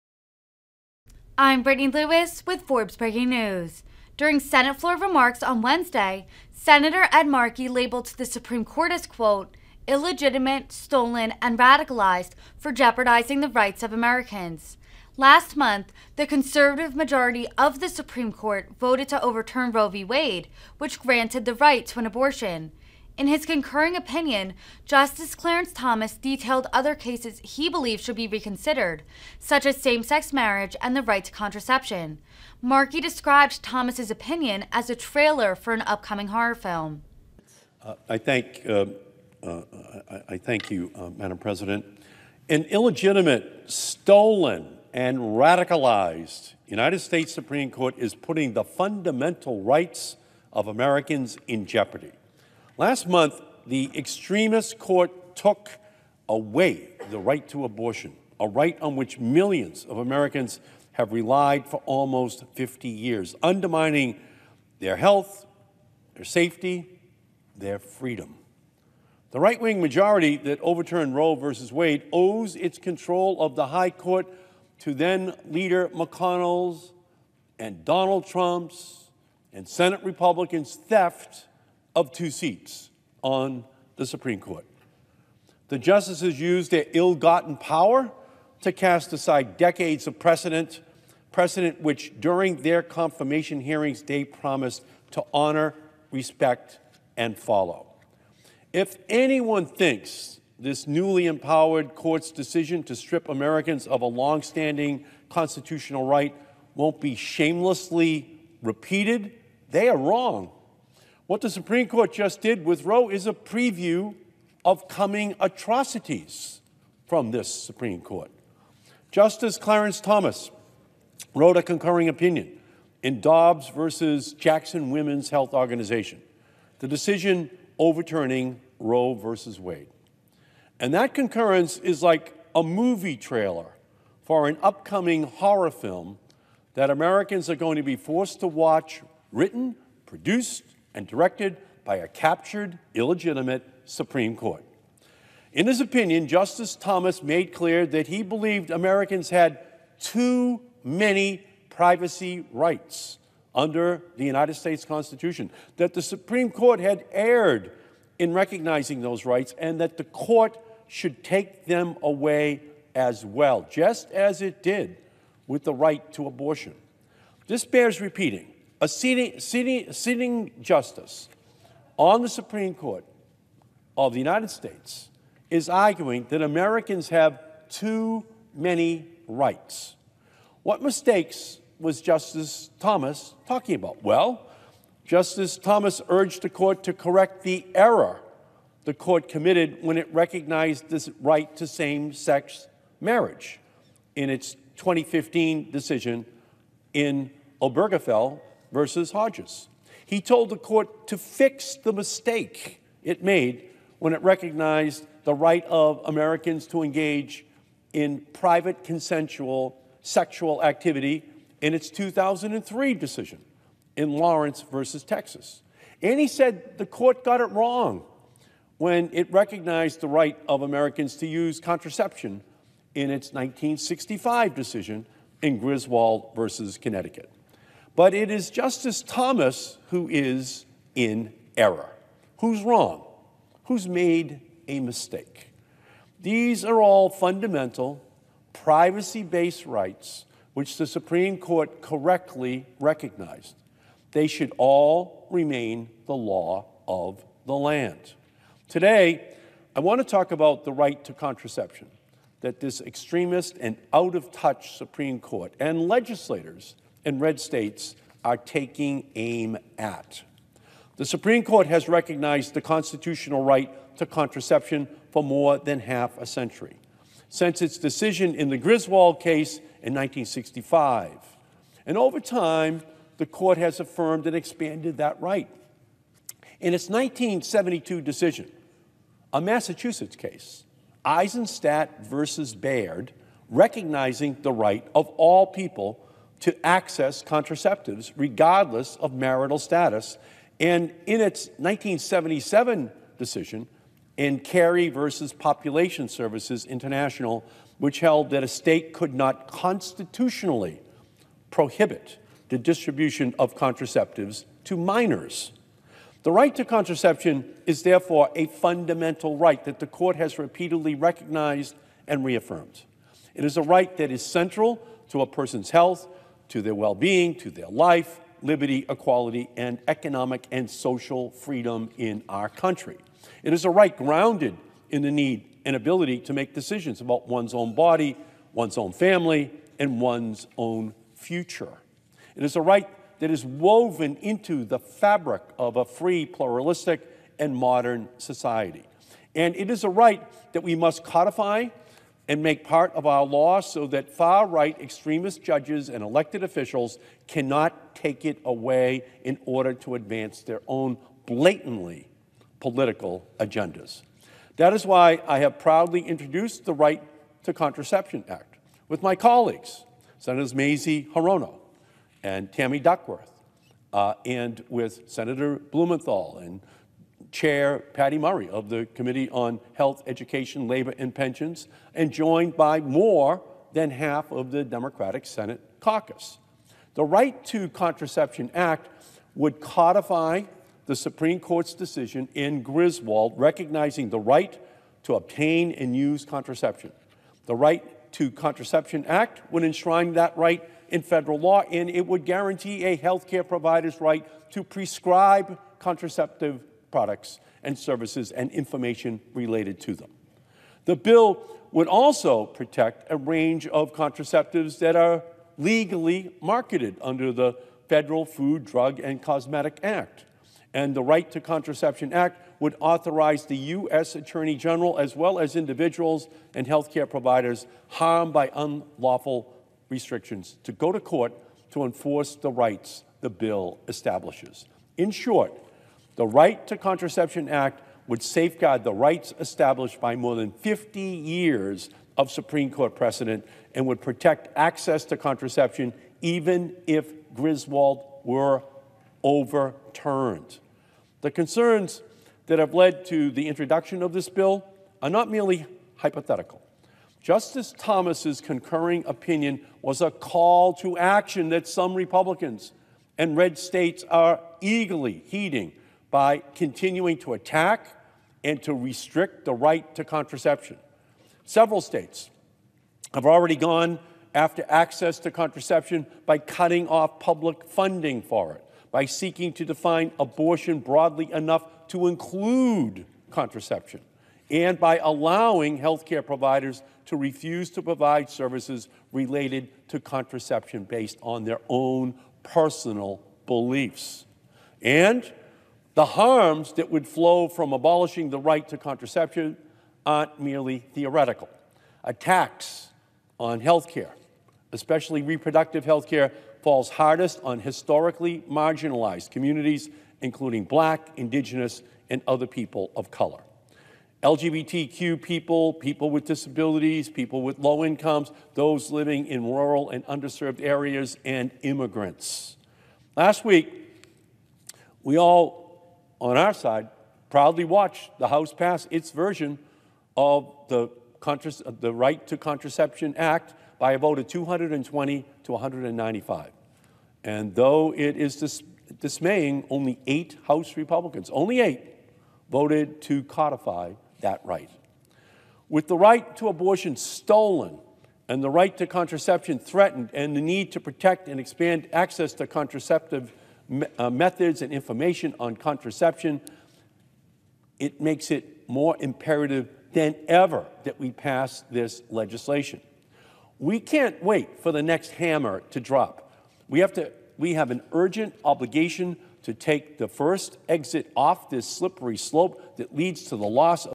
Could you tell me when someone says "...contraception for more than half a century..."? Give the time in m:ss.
4:24.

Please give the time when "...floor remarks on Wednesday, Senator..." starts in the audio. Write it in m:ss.
0:04.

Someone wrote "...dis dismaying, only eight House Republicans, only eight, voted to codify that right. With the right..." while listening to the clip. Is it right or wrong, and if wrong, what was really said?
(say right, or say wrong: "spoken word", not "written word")
right.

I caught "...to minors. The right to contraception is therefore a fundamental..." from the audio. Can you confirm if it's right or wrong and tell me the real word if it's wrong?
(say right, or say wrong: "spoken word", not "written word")
right.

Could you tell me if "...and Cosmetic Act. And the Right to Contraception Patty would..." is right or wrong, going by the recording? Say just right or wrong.
wrong.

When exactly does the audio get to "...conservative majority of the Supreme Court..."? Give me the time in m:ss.
0:16.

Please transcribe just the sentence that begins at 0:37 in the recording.
Uh, I, thank, uh, uh, I, I, thank you, uh, Madam President.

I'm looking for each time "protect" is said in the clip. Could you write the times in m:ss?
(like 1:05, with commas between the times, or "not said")
6:42, 7:14, 9:00.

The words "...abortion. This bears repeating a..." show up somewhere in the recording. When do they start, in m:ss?
2:46.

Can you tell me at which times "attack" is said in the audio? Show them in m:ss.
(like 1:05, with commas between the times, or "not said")
7:37, 8:12.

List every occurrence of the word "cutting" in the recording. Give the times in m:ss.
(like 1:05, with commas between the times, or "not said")
7:46.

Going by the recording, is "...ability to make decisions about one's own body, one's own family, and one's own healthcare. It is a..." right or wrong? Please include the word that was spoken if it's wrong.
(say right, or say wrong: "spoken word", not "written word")
wrong: "future", not "healthcare".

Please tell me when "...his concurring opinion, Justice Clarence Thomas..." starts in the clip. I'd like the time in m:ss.
0:23.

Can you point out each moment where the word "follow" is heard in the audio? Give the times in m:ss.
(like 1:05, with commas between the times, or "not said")
1:37.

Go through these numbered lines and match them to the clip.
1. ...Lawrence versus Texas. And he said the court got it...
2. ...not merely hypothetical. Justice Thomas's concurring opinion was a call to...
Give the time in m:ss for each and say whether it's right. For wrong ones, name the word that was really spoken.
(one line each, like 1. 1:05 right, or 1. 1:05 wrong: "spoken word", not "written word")
1. 3:34 right
2. 7:25 right.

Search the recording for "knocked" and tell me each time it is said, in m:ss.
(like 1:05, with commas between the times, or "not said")
not said.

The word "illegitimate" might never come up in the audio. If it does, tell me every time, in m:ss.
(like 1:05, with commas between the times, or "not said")
0:09, 0:42, 2:22.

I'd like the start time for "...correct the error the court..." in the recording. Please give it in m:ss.
3:06.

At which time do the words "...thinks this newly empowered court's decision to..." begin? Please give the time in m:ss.
1:39.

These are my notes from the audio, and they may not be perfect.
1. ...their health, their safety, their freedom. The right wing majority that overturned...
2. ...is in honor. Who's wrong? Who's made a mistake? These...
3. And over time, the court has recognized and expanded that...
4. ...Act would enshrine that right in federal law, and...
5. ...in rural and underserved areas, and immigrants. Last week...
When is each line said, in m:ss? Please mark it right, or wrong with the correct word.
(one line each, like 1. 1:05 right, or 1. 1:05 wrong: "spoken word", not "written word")
1. 1:04 right
2. 3:50 wrong: "error", not "honor"
3. 4:31 wrong: "affirmed", not "recognized"
4. 6:29 right
5. 8:29 right.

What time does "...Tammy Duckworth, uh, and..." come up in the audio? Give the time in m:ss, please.
6:02.